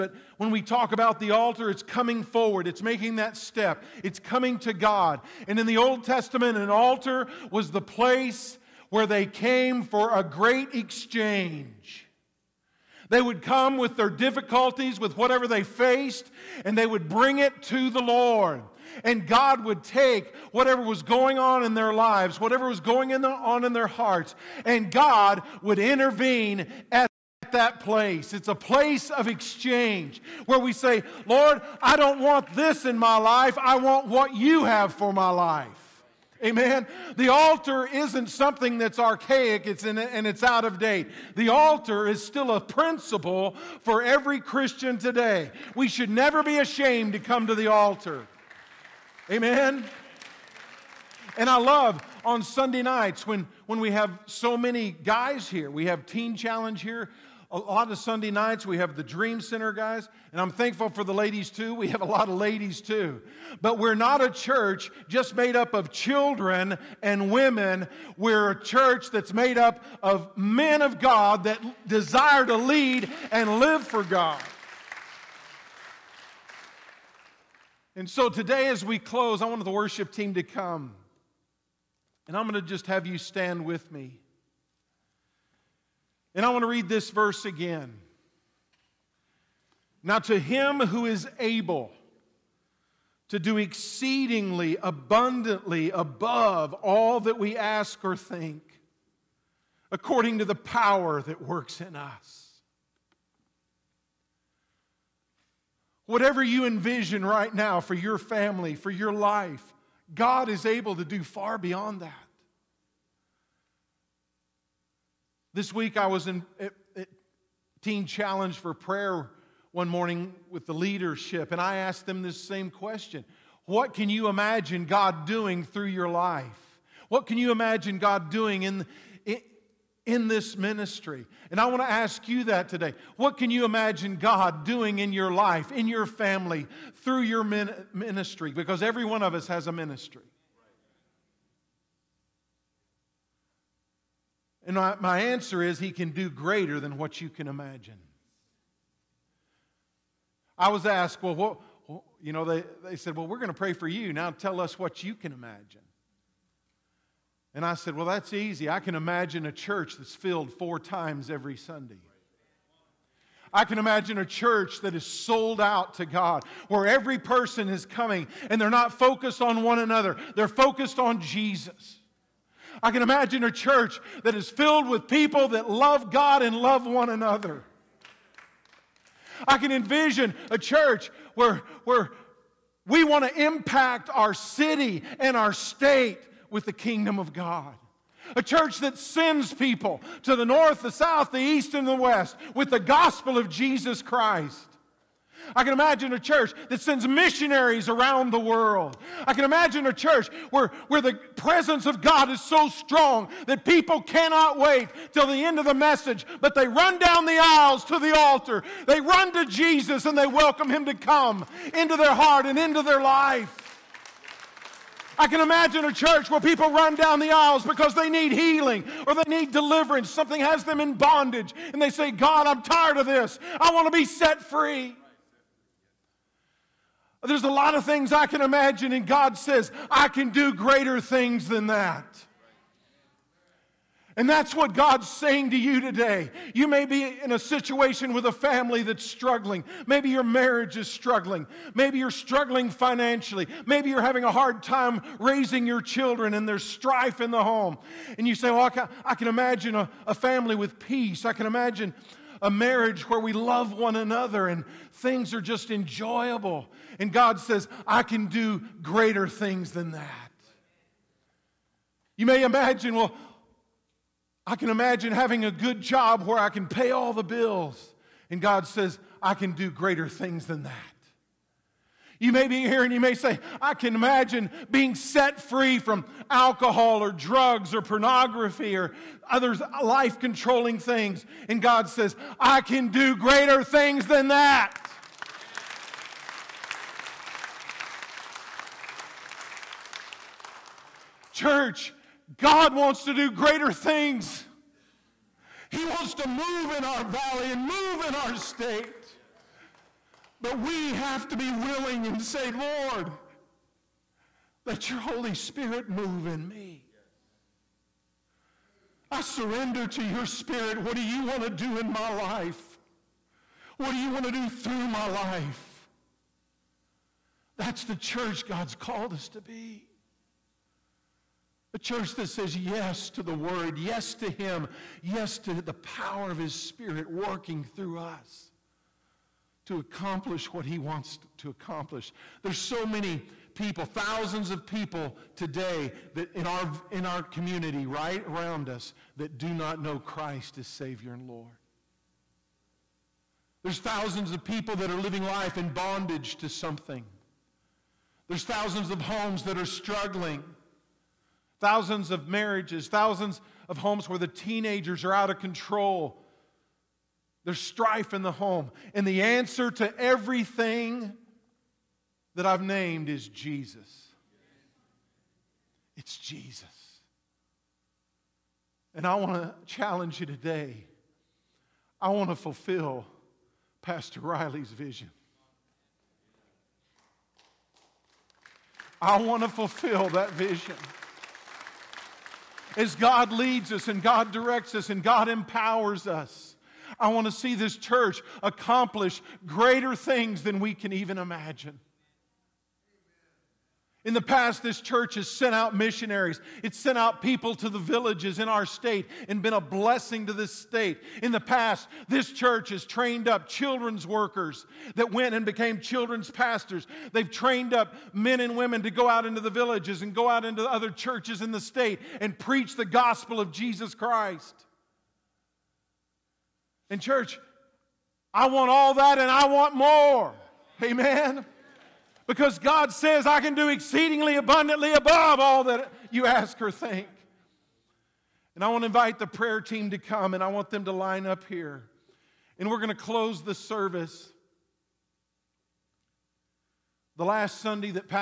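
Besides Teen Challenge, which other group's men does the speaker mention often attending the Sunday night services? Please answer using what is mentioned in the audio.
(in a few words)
Dream Center.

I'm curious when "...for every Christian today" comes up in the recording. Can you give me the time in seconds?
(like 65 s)
43 s.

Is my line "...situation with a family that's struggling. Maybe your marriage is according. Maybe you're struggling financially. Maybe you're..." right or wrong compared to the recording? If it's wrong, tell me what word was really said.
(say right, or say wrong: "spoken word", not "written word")
wrong: "struggling", not "according".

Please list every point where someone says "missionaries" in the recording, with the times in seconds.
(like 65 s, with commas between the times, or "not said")
197 s, 395 s.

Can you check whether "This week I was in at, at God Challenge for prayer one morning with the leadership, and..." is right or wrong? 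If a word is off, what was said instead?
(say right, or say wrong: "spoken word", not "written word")
wrong: "Teen", not "God".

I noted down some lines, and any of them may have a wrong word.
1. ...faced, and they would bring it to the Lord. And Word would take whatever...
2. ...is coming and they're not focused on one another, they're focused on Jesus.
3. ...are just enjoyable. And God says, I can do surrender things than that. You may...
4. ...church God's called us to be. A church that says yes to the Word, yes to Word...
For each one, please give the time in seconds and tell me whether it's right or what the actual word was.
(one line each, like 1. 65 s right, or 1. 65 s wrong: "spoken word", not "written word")
1. 15 s wrong: "God", not "Word"
2. 167 s right
3. 255 s wrong: "greater", not "surrender"
4. 317 s wrong: "Him", not "Word".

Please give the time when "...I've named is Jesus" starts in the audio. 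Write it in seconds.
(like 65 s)
362 s.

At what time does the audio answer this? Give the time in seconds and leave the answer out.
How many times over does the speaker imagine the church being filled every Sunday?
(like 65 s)
160 s.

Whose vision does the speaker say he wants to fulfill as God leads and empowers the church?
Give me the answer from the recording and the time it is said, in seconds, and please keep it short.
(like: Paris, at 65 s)
Pastor Riley, at 373 s.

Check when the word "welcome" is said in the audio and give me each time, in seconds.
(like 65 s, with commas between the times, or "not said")
210 s.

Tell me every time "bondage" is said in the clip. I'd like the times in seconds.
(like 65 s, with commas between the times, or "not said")
220 s, 345 s.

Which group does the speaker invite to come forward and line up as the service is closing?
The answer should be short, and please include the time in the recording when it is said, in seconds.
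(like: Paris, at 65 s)
the prayer team, at 429 s.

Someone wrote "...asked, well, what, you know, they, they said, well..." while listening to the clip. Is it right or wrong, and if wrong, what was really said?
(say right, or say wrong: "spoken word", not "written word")
right.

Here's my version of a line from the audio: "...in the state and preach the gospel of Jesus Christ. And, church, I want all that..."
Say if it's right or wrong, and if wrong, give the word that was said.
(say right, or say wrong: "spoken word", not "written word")
right.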